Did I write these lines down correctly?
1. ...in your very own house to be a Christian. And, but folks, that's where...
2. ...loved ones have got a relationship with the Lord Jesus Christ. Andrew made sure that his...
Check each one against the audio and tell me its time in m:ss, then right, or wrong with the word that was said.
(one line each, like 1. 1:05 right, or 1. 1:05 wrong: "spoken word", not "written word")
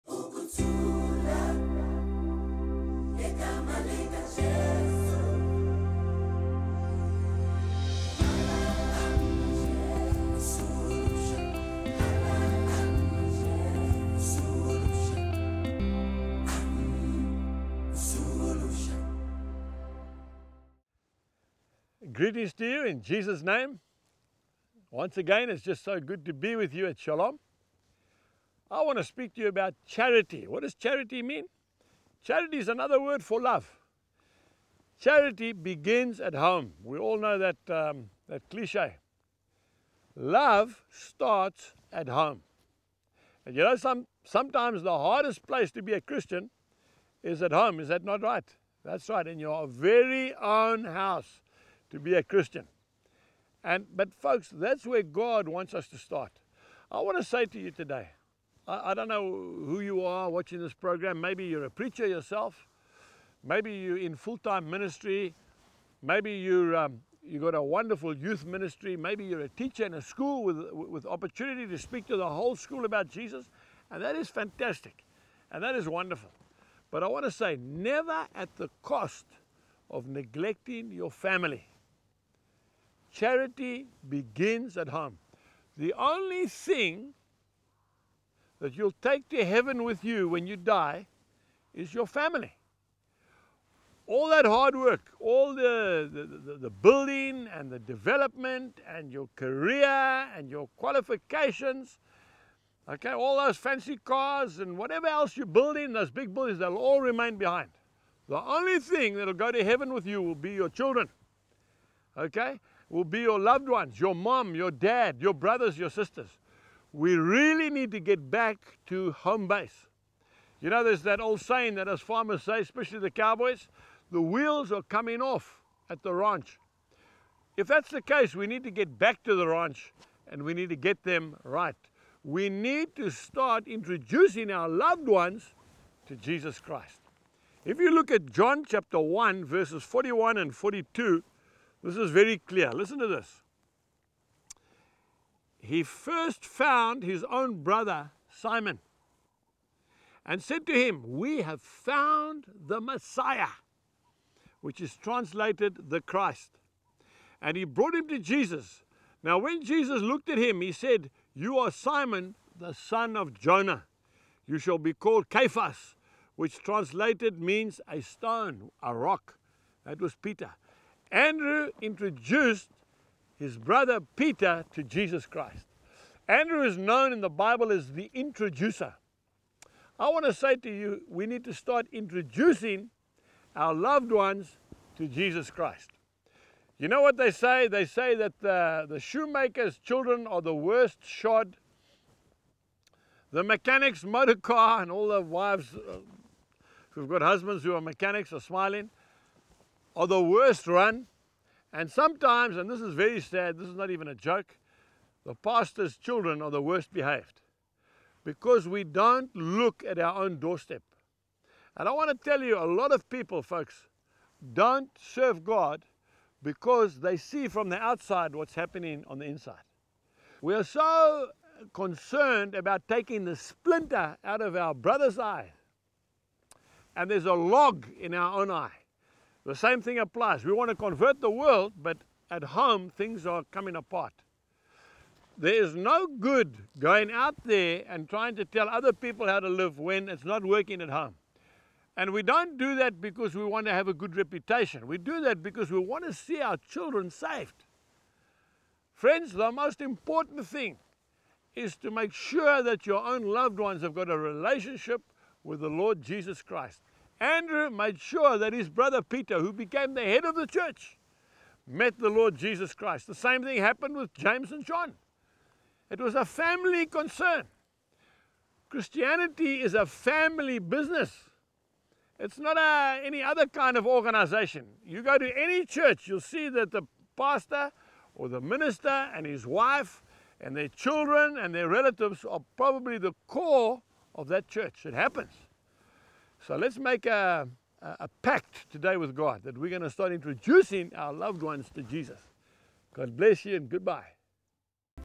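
1. 0:49 right
2. 4:13 right.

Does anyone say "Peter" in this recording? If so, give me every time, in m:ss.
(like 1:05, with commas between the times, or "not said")
2:50, 2:54, 4:19.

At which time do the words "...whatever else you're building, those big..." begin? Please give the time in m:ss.
1:44.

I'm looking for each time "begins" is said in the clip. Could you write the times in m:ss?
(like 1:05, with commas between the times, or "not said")
0:35, 1:24.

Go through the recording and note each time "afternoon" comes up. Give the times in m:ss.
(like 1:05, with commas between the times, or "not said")
not said.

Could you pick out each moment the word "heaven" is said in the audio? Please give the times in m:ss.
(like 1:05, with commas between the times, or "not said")
1:29, 1:49.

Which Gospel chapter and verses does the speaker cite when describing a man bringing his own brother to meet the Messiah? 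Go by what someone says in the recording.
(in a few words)
John 1:41-42.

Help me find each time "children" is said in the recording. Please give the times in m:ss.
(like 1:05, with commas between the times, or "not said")
1:50, 3:09, 3:25, 4:06, 4:40.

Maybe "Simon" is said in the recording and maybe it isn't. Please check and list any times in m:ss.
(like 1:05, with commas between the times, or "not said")
2:28, 2:41.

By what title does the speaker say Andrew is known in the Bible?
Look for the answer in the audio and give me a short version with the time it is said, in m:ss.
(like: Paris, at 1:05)
the introducer, at 2:57.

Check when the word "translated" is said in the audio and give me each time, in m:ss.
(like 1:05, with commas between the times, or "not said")
2:34, 2:46.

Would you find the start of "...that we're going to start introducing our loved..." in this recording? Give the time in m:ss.
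4:49.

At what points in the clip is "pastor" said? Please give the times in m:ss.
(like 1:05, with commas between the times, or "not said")
3:25, 4:37.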